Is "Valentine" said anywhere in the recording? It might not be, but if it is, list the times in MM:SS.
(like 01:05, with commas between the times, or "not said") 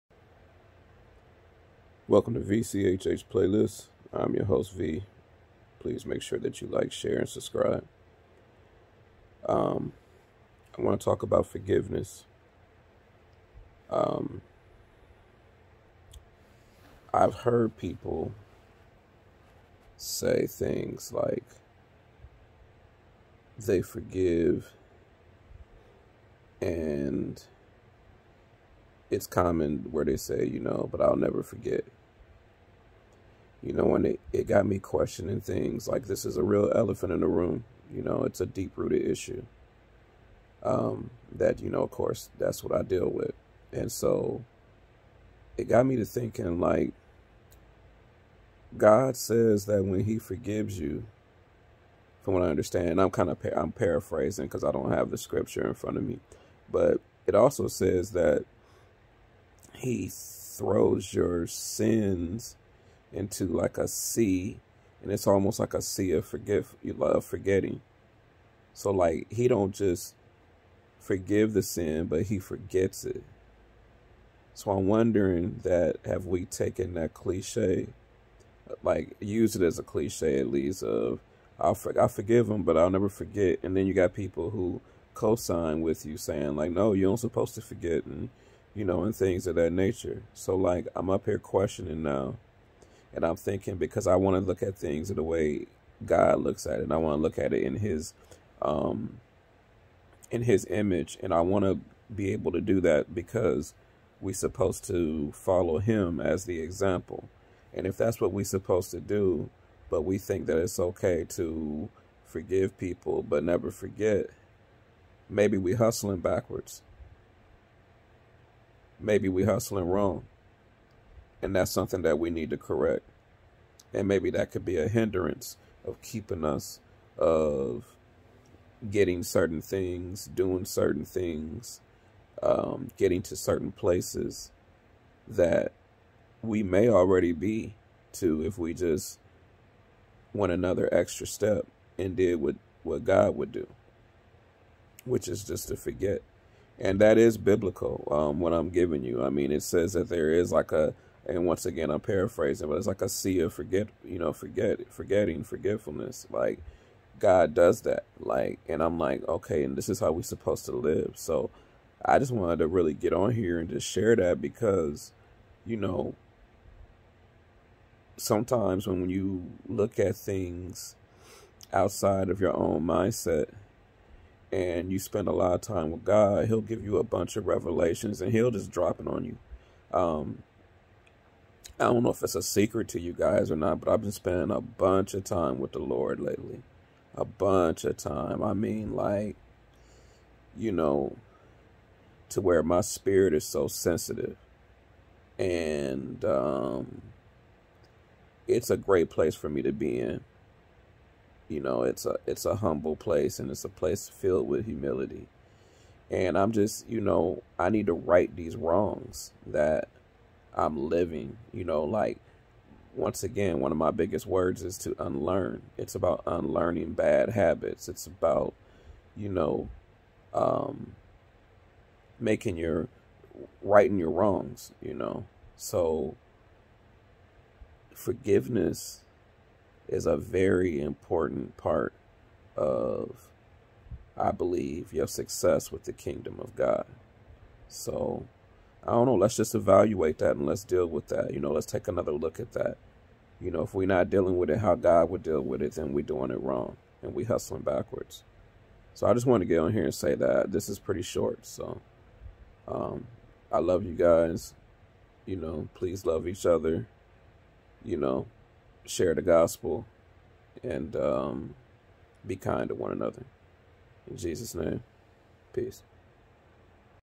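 not said.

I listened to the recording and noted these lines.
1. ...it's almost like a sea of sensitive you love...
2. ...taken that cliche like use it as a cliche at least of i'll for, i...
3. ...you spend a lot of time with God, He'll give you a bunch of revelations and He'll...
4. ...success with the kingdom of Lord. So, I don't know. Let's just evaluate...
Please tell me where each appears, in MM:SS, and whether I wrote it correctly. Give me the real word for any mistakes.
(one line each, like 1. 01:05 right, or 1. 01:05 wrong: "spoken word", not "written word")
1. 01:05 wrong: "forgive", not "sensitive"
2. 01:16 right
3. 02:54 right
4. 03:55 wrong: "God", not "Lord".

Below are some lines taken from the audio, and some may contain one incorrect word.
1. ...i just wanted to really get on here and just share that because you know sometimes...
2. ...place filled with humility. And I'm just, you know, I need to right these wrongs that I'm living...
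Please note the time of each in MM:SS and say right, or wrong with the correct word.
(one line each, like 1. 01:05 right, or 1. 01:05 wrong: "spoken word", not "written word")
1. 02:42 right
2. 03:23 right.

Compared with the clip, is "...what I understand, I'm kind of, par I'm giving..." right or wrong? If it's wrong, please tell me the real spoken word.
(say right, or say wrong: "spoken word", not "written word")
wrong: "paraphrasing", not "giving".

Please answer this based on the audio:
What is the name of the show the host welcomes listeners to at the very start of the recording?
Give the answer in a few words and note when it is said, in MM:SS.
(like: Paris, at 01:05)
VCHH Playlist, at 00:02.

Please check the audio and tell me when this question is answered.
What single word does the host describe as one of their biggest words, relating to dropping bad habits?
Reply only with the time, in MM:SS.
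03:34.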